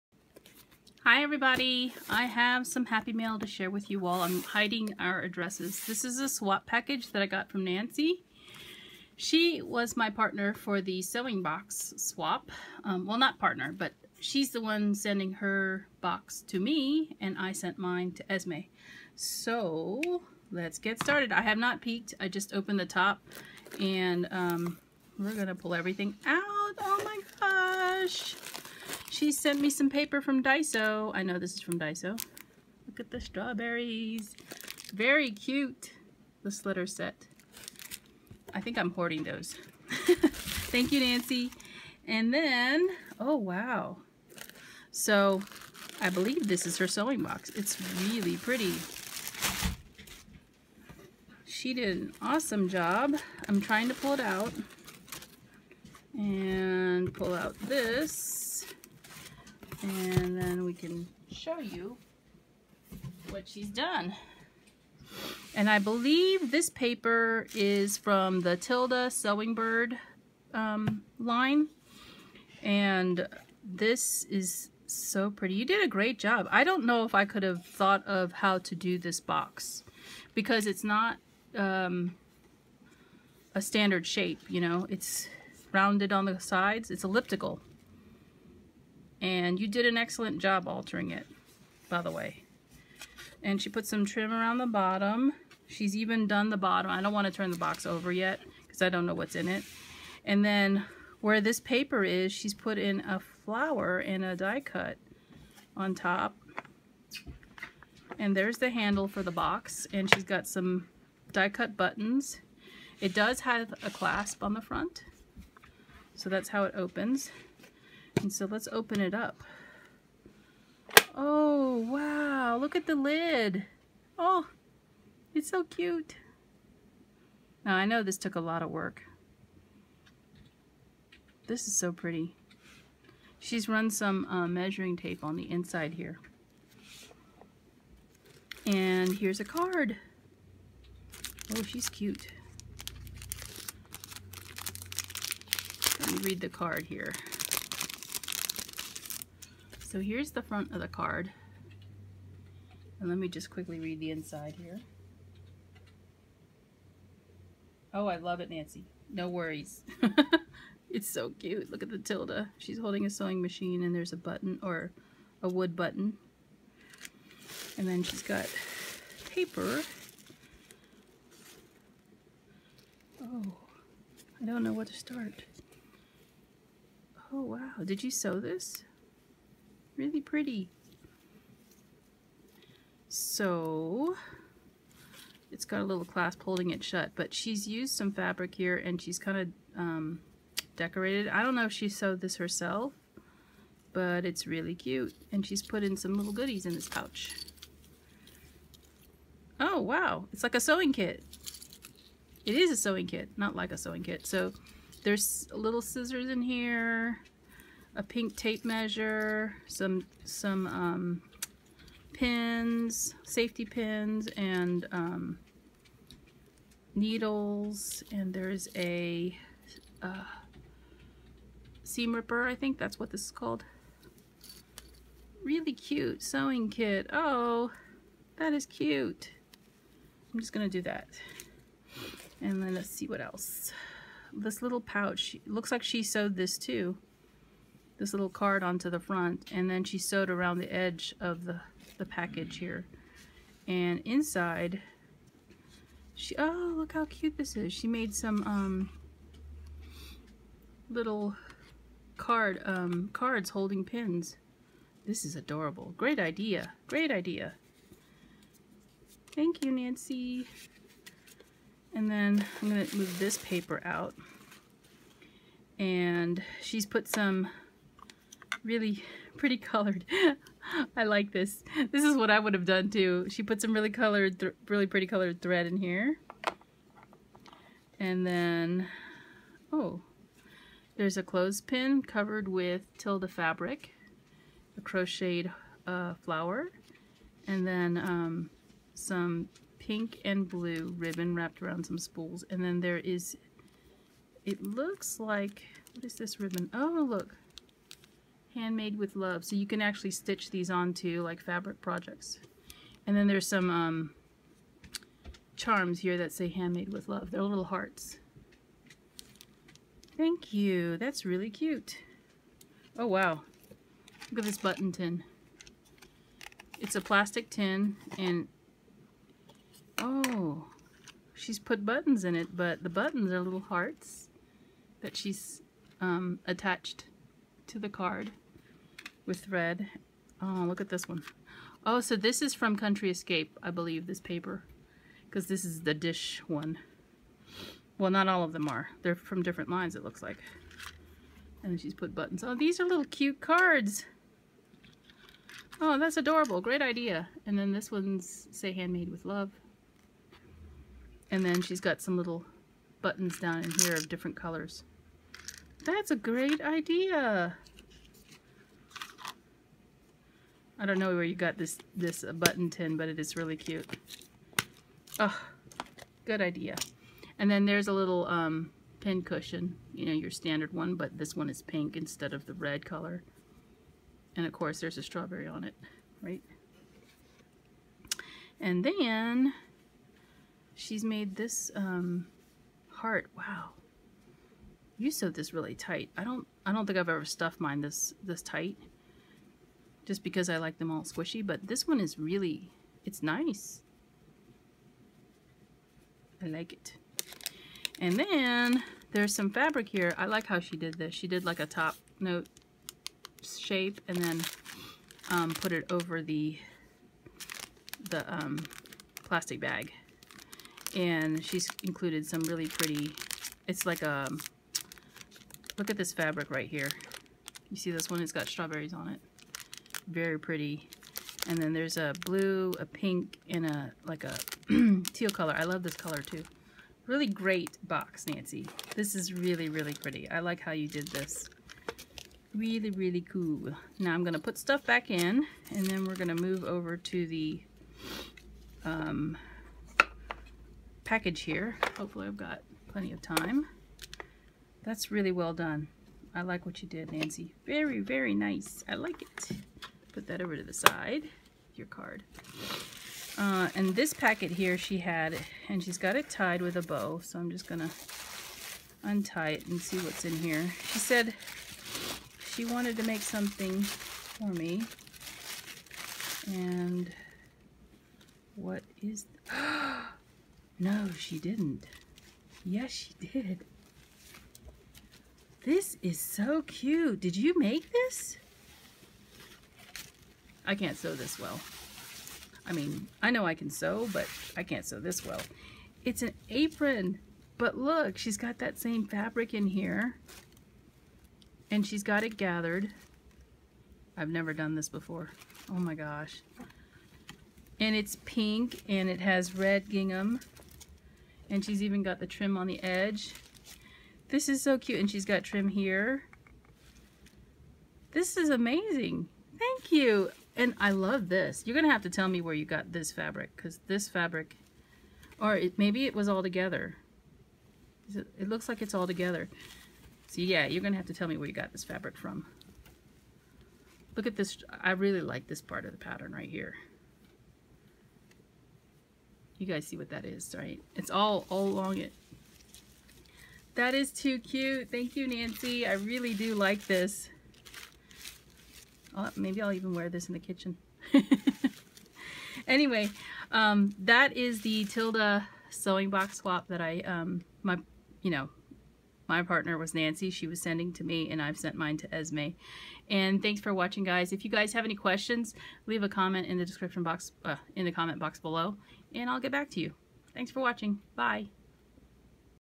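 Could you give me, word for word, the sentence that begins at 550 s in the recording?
She was sending to me and I've sent mine to Esme.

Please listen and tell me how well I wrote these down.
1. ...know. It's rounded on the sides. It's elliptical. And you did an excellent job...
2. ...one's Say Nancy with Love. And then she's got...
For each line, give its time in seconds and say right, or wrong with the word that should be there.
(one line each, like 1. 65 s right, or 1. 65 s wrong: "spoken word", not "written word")
1. 84 s right
2. 347 s wrong: "Handmade", not "Nancy".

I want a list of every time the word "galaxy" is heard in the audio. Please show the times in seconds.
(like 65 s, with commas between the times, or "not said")
not said.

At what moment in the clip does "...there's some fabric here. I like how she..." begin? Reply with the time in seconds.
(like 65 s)
399 s.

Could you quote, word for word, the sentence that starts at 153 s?
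And let me just quickly read the inside here.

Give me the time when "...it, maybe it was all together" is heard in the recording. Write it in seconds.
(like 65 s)
515 s.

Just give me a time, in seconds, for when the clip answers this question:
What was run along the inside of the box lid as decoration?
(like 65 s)
134 s.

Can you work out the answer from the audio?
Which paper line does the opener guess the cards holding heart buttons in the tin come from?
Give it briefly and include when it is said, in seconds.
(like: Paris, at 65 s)
Country Escape, at 332 s.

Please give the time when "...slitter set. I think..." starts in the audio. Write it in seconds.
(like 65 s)
36 s.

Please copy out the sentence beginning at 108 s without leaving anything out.
And there's the handle for the box.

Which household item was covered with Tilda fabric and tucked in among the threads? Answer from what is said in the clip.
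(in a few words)
clothespin.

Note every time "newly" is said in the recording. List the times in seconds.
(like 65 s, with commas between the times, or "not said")
not said.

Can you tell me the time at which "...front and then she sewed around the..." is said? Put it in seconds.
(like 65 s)
238 s.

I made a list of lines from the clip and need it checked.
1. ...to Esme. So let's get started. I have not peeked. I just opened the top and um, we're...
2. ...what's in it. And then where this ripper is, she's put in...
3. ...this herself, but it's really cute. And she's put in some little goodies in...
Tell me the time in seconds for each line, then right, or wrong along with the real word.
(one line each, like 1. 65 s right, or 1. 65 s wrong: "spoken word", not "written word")
1. 18 s right
2. 99 s wrong: "paper", not "ripper"
3. 192 s right.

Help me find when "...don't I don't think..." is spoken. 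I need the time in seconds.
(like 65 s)
386 s.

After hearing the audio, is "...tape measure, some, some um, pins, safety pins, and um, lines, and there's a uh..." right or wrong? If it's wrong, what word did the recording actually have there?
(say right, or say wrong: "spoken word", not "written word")
wrong: "needles", not "lines".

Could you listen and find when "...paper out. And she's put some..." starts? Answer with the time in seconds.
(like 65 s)
263 s.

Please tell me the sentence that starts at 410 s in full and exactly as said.
And she's included some really pretty, it's like a, um, look at this fabric right here.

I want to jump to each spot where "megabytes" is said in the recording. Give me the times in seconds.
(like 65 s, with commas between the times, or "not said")
not said.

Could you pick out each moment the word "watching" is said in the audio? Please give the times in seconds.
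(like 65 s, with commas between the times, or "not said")
553 s, 560 s.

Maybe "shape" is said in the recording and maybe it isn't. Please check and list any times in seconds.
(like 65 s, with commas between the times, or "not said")
84 s, 403 s.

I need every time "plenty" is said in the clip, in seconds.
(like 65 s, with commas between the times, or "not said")
442 s.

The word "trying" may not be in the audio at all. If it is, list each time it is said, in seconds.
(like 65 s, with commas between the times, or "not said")
53 s.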